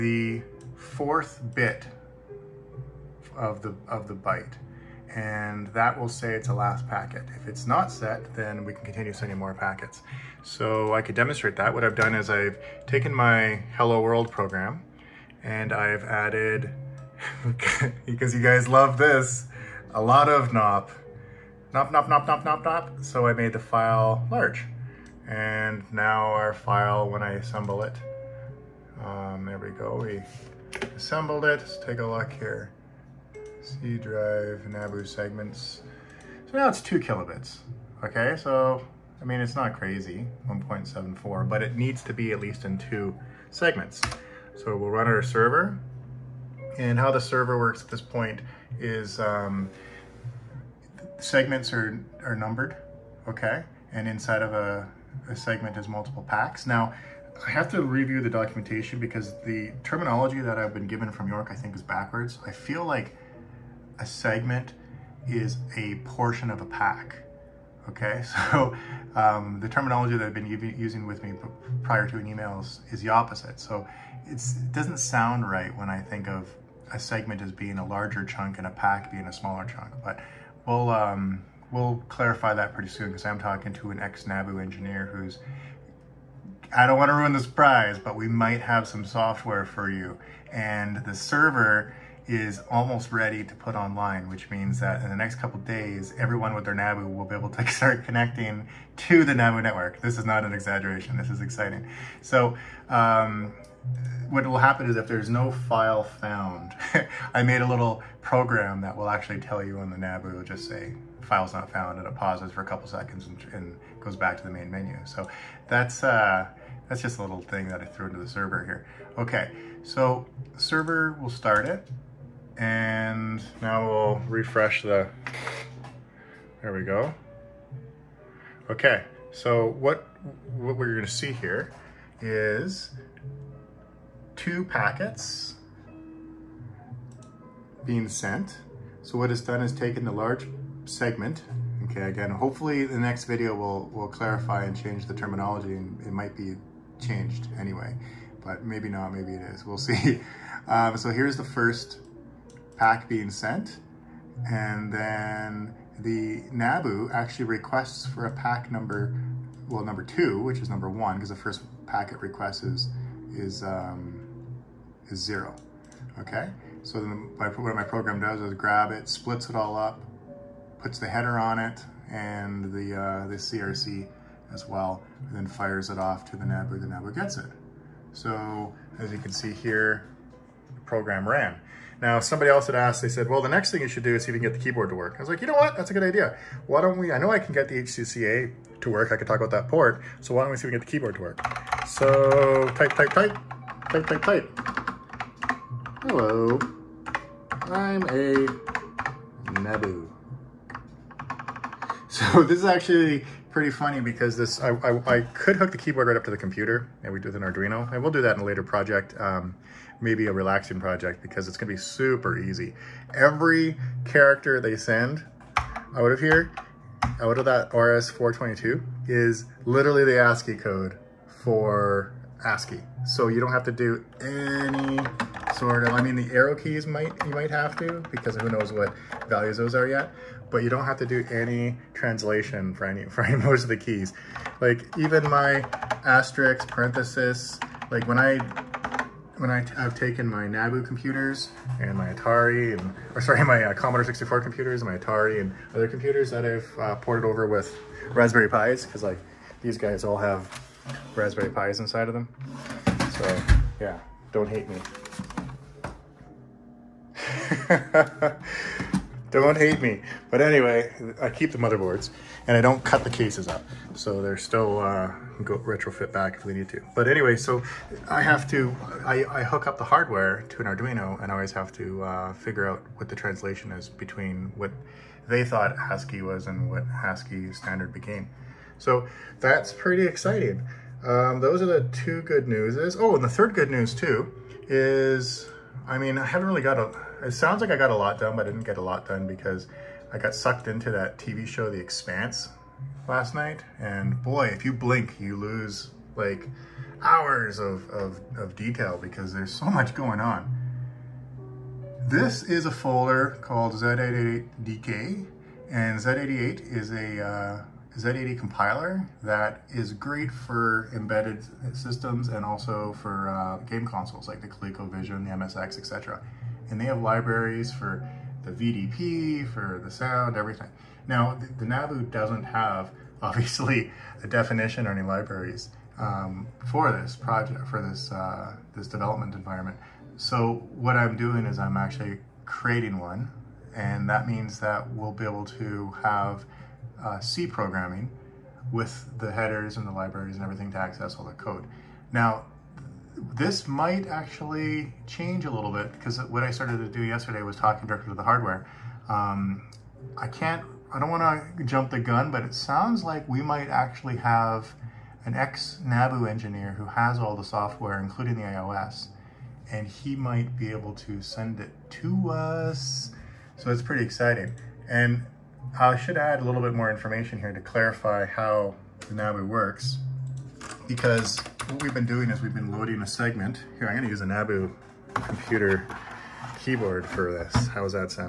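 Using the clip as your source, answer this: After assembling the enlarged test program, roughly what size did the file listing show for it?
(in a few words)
1.74.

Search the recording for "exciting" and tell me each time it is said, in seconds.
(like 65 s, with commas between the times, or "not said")
101 s, 280 s, 364 s.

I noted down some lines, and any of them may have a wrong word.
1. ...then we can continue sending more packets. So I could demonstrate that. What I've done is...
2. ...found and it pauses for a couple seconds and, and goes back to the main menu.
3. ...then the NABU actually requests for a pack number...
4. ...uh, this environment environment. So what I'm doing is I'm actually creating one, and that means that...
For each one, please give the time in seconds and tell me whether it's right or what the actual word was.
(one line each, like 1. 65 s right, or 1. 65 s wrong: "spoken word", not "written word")
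1. 8 s right
2. 111 s right
3. 154 s right
4. 328 s wrong: "development", not "environment".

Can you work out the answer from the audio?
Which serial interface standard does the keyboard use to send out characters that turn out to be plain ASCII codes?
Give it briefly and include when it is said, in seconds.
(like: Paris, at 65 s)
RS-422, at 217 s.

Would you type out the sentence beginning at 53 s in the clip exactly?
And inside of a, a segment is multiple packs.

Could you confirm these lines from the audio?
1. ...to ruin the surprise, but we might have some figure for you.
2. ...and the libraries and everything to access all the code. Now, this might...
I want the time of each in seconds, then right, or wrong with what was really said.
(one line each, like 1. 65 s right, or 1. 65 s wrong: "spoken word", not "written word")
1. 87 s wrong: "software", not "figure"
2. 339 s right.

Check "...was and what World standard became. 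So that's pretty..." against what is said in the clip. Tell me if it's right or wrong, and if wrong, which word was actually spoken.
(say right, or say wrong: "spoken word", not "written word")
wrong: "ASCII", not "World".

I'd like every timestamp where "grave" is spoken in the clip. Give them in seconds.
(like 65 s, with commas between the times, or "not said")
not said.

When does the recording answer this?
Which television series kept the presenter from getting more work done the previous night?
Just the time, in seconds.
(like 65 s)
291 s.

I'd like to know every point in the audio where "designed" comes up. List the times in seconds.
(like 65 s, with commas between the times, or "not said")
not said.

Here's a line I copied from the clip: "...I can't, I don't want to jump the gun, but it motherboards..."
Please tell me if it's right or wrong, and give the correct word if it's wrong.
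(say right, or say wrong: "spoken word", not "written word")
wrong: "sounds", not "motherboards".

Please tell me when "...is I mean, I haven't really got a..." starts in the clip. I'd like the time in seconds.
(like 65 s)
284 s.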